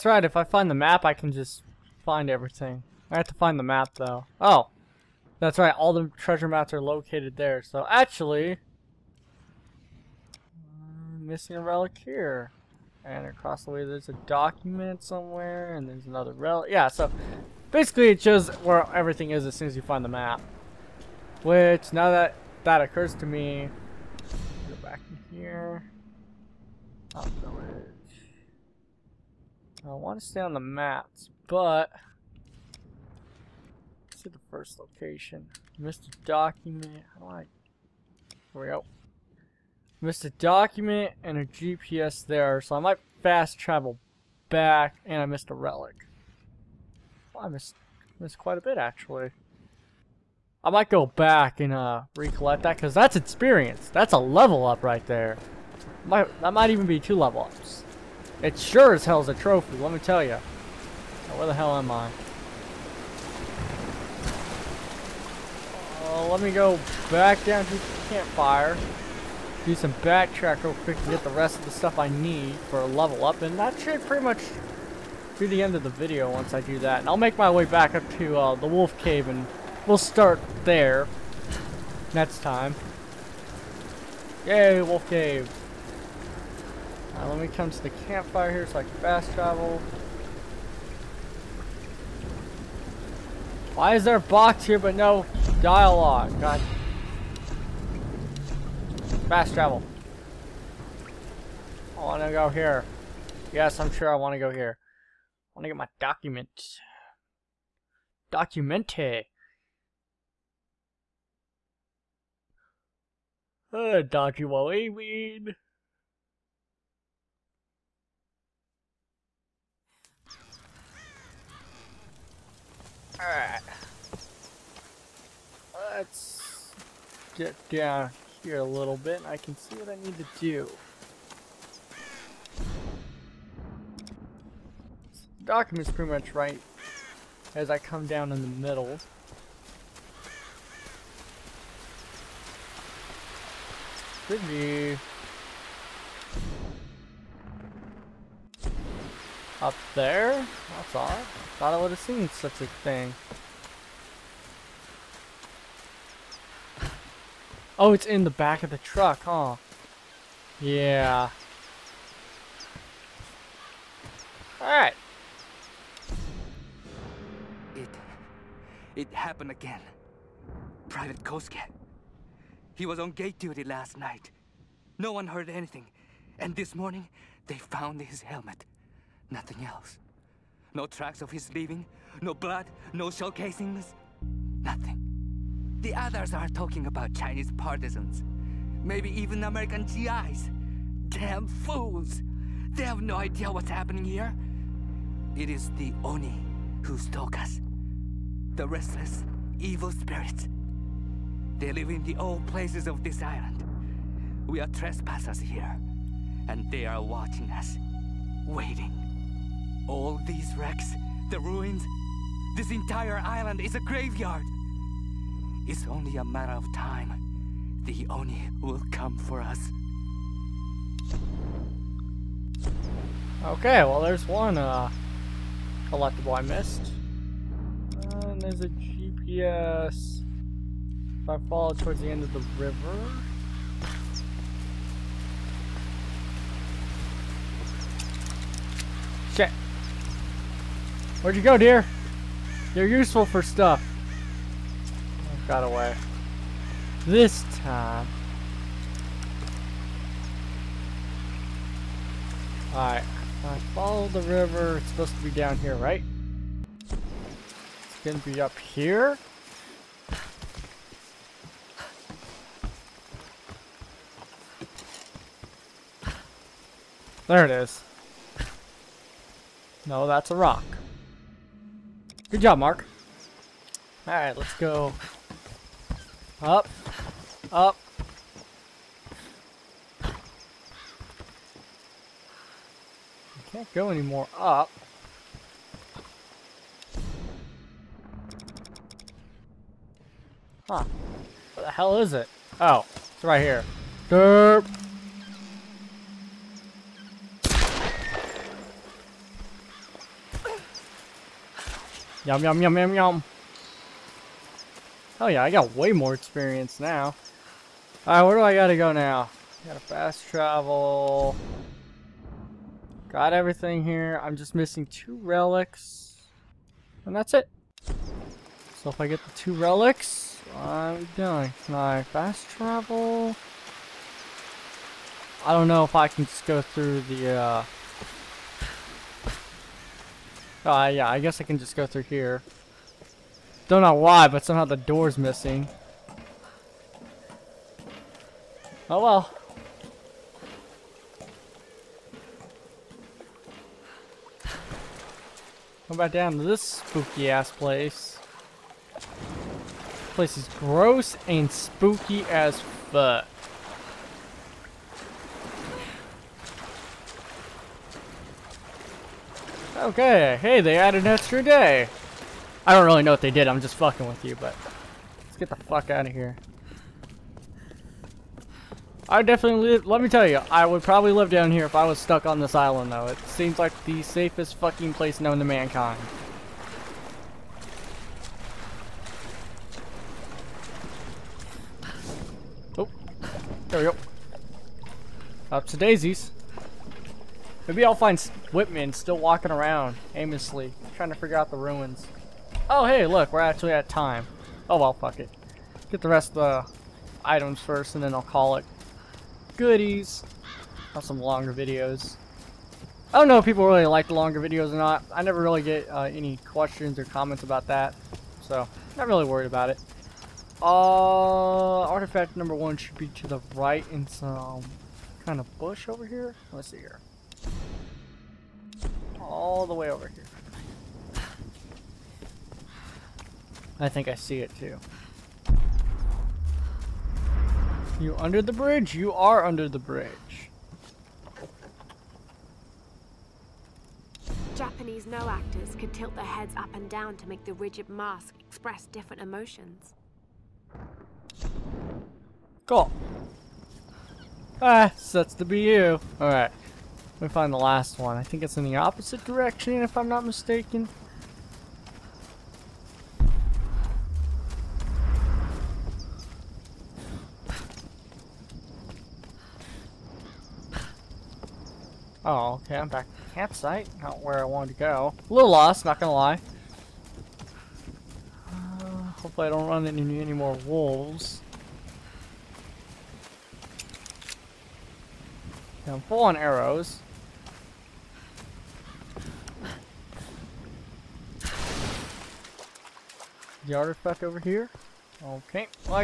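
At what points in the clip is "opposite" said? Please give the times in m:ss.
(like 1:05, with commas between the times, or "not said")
7:28.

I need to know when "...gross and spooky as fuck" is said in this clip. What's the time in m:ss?
5:50.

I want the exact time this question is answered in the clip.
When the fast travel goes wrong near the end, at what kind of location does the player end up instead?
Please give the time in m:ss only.
7:43.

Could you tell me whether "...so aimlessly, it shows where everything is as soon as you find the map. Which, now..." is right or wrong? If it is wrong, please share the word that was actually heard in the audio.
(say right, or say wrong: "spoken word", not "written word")
wrong: "basically", not "aimlessly".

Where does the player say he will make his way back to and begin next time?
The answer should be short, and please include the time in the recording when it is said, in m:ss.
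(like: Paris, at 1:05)
the Wolf Cave, at 1:18.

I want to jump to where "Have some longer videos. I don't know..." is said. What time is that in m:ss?
6:40.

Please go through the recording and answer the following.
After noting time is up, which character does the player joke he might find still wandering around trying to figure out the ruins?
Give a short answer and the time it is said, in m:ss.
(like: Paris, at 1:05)
Whitman, at 6:28.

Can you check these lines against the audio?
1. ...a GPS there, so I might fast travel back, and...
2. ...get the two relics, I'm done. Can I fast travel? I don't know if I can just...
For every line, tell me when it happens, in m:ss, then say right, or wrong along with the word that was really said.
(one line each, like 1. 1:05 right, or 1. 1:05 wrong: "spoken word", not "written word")
1. 0:41 right
2. 5:19 right.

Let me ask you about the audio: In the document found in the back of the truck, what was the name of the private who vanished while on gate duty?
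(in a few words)
Private Kosuke.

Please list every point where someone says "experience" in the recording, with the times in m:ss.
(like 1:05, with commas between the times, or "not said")
0:53, 5:06.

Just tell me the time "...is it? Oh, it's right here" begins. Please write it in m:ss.
4:51.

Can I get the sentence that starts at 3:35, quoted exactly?
It's only a matter of time.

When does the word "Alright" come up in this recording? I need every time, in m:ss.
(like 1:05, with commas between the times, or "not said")
2:03, 2:44, 4:12, 4:34, 5:08, 7:26.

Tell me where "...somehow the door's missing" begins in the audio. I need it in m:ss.
5:34.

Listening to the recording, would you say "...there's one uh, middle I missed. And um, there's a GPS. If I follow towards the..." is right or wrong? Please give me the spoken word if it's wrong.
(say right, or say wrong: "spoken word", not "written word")
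wrong: "collectible", not "middle".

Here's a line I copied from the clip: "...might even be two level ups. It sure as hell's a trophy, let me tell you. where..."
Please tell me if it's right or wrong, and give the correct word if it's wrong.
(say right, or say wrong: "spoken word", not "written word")
right.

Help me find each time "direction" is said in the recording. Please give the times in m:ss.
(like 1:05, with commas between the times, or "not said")
7:29.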